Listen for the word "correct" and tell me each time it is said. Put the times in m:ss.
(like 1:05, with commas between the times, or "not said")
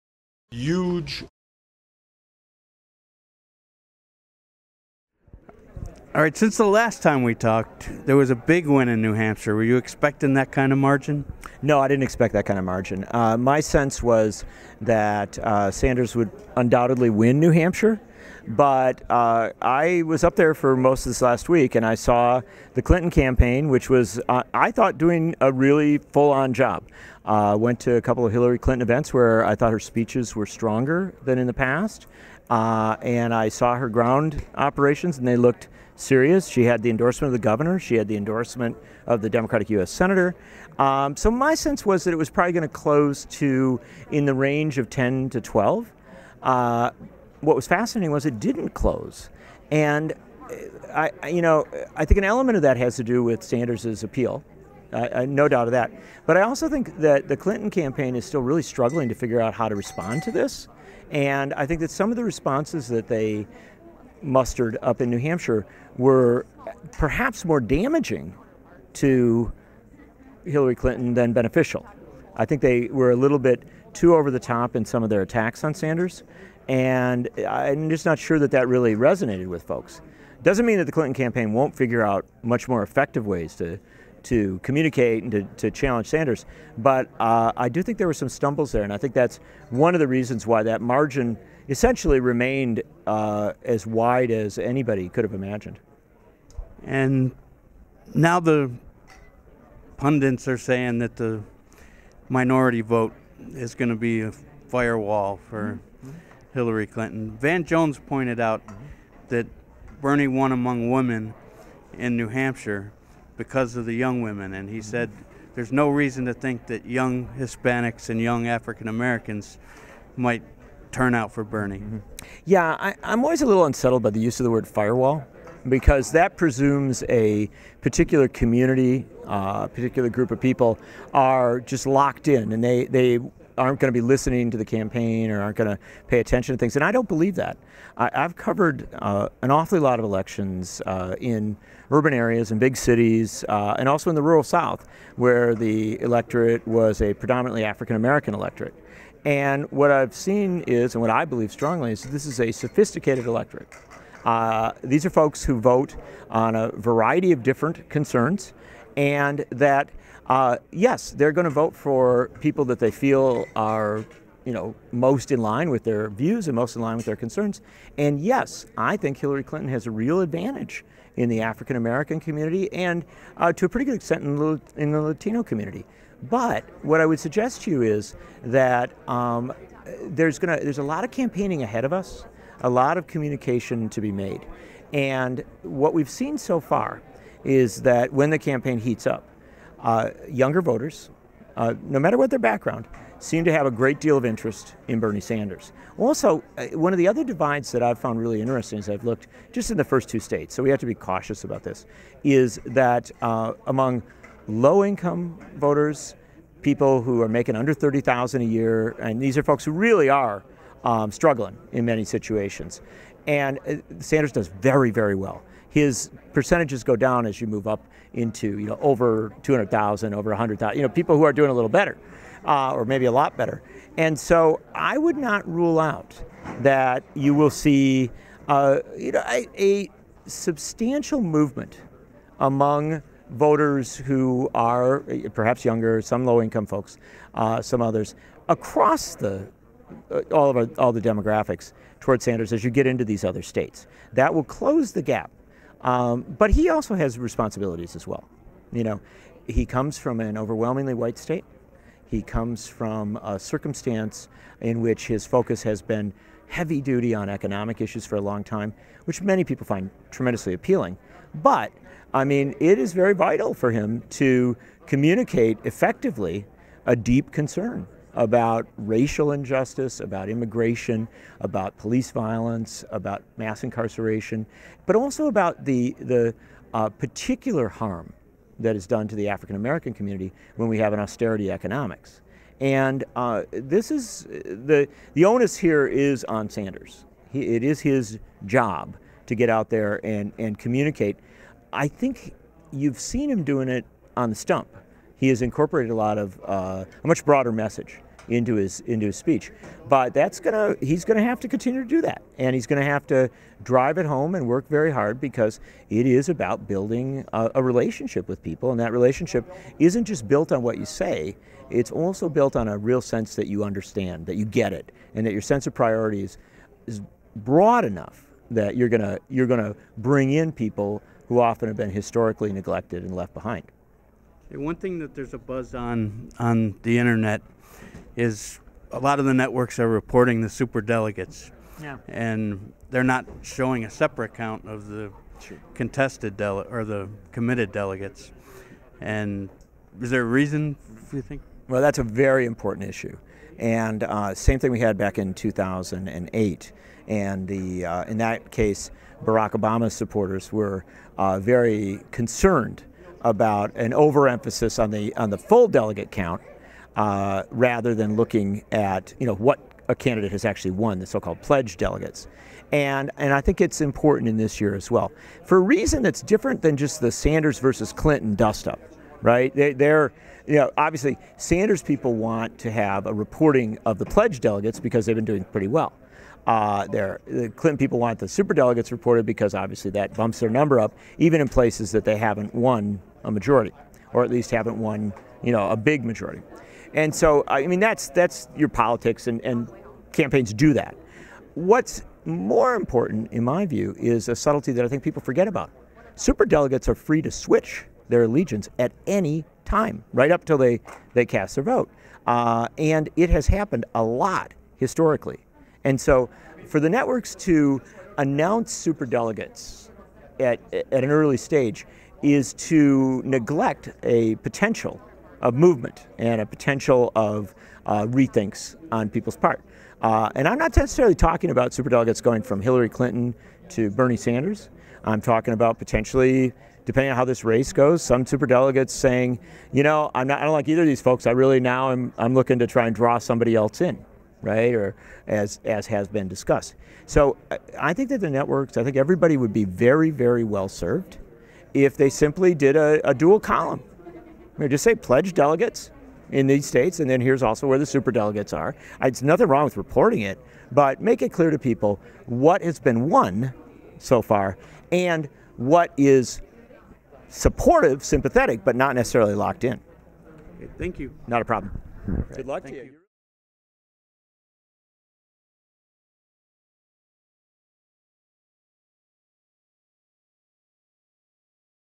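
not said.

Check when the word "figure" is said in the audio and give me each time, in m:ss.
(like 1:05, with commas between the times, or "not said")
0:59, 1:21.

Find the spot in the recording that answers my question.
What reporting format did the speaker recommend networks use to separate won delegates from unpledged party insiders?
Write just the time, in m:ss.
7:23.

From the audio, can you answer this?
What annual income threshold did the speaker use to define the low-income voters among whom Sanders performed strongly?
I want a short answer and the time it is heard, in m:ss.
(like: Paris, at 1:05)
30,000, at 3:27.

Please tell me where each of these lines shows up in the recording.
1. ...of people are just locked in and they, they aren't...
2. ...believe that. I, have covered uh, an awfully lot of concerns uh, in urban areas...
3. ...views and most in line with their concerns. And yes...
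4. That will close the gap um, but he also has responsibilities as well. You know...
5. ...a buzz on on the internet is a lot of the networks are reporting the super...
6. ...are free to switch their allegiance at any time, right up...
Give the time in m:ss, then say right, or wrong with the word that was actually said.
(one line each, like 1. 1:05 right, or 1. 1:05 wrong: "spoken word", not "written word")
1. 2:10 right
2. 2:17 wrong: "elections", not "concerns"
3. 2:46 right
4. 4:04 right
5. 5:25 right
6. 6:36 right.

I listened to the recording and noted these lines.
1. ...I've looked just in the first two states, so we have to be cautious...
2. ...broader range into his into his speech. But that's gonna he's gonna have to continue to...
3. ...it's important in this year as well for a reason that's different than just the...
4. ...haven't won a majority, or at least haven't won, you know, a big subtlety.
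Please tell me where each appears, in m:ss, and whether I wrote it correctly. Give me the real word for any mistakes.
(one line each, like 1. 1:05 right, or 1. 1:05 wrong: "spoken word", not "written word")
1. 3:18 right
2. 4:57 wrong: "message", not "range"
3. 6:03 right
4. 6:22 wrong: "majority", not "subtlety".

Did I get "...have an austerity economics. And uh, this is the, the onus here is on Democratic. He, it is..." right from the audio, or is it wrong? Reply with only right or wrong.
wrong.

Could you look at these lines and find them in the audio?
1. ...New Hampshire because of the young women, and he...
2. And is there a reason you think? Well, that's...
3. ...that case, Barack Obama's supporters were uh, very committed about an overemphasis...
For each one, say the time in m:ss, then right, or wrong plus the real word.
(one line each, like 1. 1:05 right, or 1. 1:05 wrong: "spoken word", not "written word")
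1. 1:52 right
2. 5:38 right
3. 5:48 wrong: "concerned", not "committed".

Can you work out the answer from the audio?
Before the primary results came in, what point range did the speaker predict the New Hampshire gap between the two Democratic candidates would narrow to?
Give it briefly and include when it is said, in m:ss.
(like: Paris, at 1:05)
10 to 12, at 0:44.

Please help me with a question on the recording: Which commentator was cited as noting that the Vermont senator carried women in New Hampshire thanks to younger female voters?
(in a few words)
Van Jones.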